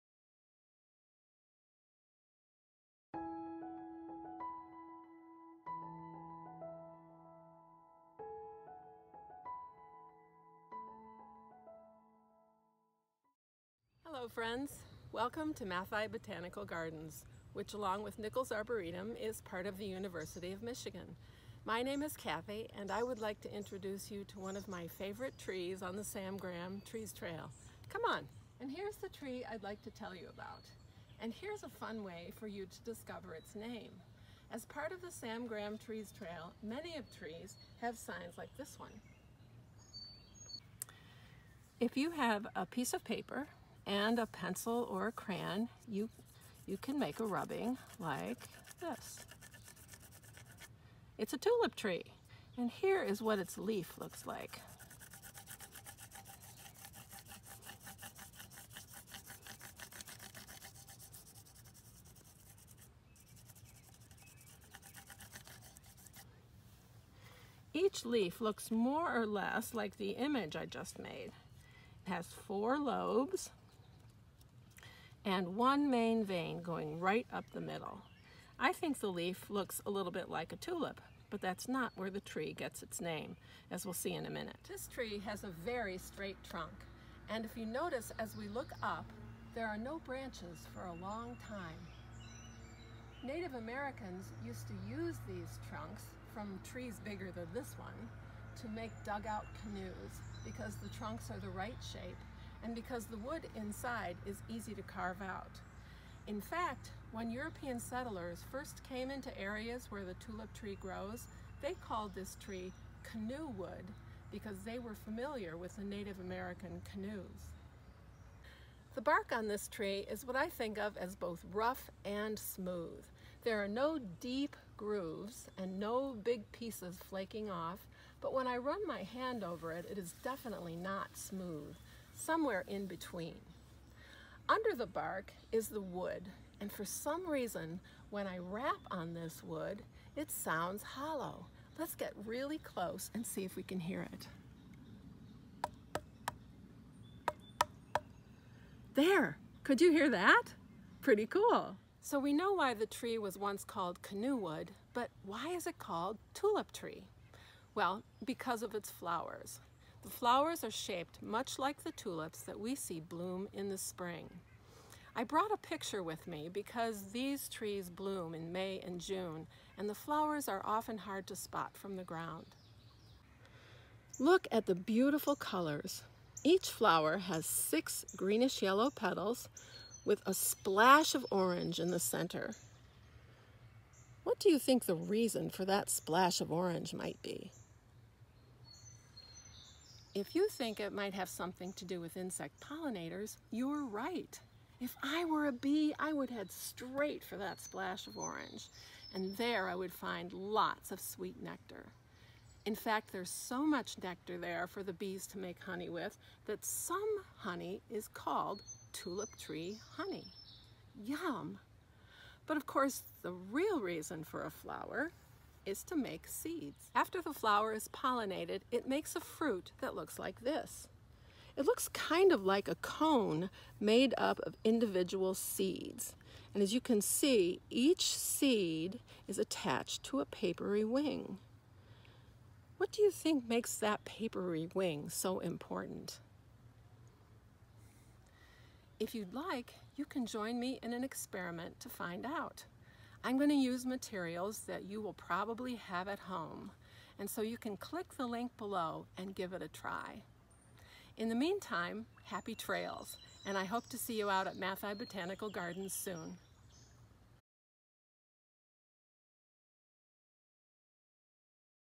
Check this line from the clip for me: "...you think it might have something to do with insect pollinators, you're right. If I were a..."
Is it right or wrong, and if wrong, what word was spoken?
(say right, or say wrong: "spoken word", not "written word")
right.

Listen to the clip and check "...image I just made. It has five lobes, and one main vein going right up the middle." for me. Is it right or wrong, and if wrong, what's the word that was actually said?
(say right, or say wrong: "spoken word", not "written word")
wrong: "four", not "five".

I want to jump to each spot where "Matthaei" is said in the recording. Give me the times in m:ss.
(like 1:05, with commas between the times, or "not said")
0:15, 4:14.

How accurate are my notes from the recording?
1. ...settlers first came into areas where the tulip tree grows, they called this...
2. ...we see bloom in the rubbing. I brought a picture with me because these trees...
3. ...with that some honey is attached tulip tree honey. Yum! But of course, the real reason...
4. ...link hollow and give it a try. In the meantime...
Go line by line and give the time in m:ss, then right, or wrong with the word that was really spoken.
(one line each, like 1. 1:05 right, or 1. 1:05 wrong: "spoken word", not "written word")
1. 1:47 right
2. 2:42 wrong: "spring", not "rubbing"
3. 3:25 wrong: "called", not "attached"
4. 4:08 wrong: "below", not "hollow".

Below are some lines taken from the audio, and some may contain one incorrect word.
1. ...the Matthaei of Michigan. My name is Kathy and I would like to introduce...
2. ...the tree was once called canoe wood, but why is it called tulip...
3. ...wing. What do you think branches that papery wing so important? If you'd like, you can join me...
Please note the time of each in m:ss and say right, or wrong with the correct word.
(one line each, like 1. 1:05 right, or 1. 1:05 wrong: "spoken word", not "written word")
1. 0:19 wrong: "University", not "Matthaei"
2. 2:32 right
3. 3:50 wrong: "makes", not "branches".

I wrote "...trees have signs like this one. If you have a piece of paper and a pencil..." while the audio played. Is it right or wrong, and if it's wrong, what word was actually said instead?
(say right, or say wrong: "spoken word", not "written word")
right.